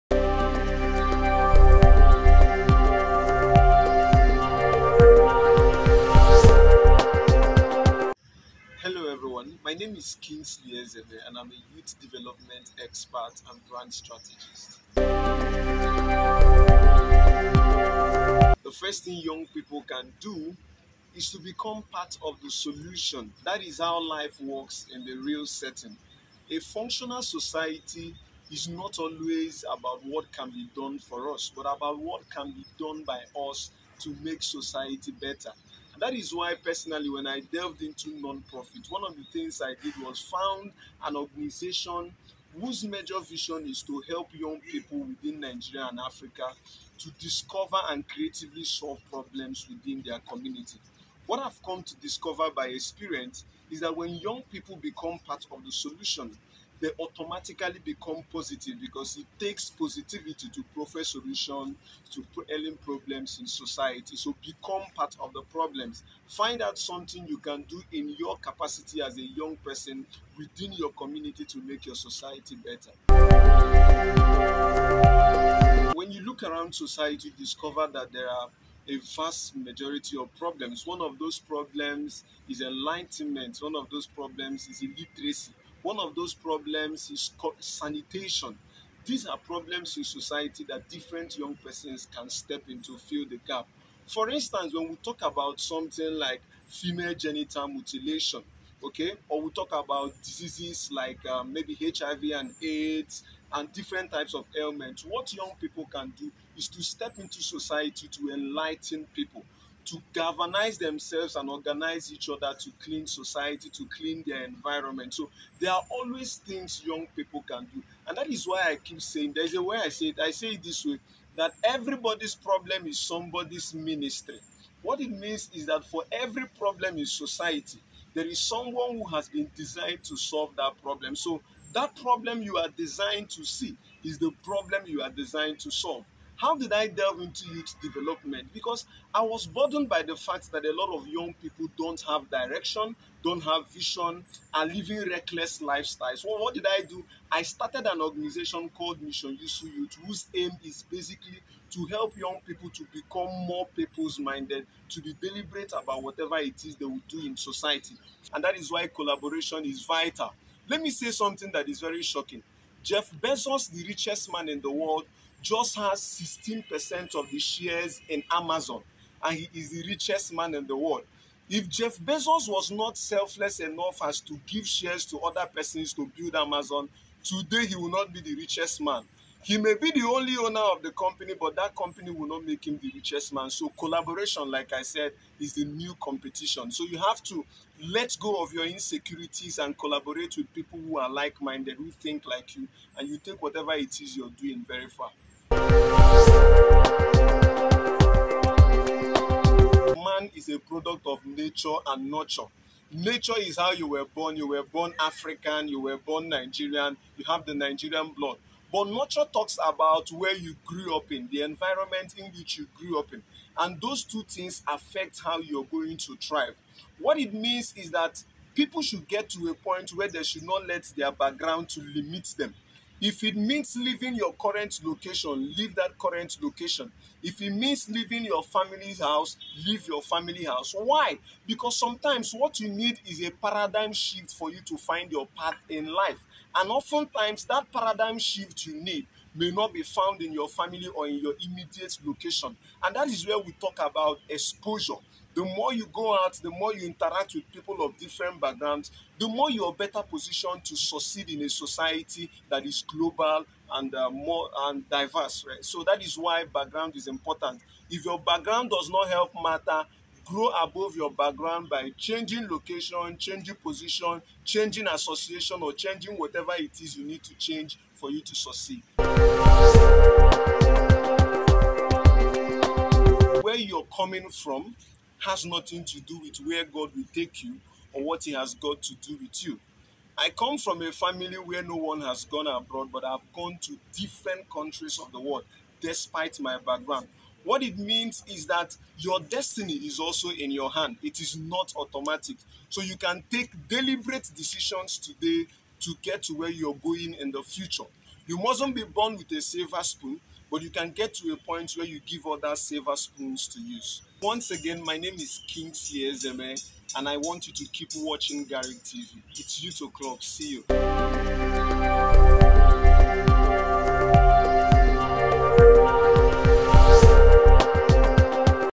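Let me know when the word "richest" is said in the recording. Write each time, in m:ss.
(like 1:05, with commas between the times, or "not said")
2:43, 2:49, 2:58, 3:02.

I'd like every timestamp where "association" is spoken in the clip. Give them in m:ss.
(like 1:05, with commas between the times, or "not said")
4:24.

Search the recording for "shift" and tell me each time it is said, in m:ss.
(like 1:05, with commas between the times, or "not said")
3:53, 3:58.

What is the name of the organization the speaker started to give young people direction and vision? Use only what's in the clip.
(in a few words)
Mission Yusu Youth.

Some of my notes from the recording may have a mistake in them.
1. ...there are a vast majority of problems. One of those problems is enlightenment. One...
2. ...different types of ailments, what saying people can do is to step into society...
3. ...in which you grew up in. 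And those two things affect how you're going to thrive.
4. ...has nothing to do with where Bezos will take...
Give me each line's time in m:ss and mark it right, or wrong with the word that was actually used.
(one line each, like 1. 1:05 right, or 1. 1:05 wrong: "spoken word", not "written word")
1. 1:18 right
2. 1:43 wrong: "young", not "saying"
3. 3:32 right
4. 4:35 wrong: "God", not "Bezos".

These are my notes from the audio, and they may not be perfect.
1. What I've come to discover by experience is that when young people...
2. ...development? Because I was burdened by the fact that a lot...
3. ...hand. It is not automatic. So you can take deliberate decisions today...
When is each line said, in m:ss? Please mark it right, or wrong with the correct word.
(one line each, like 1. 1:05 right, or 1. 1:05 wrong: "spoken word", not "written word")
1. 0:51 right
2. 2:17 right
3. 4:50 right.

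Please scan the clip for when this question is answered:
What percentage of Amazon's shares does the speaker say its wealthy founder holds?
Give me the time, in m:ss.
2:46.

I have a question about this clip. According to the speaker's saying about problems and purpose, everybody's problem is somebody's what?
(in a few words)
ministry.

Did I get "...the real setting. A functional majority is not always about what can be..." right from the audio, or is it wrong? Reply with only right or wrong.
wrong.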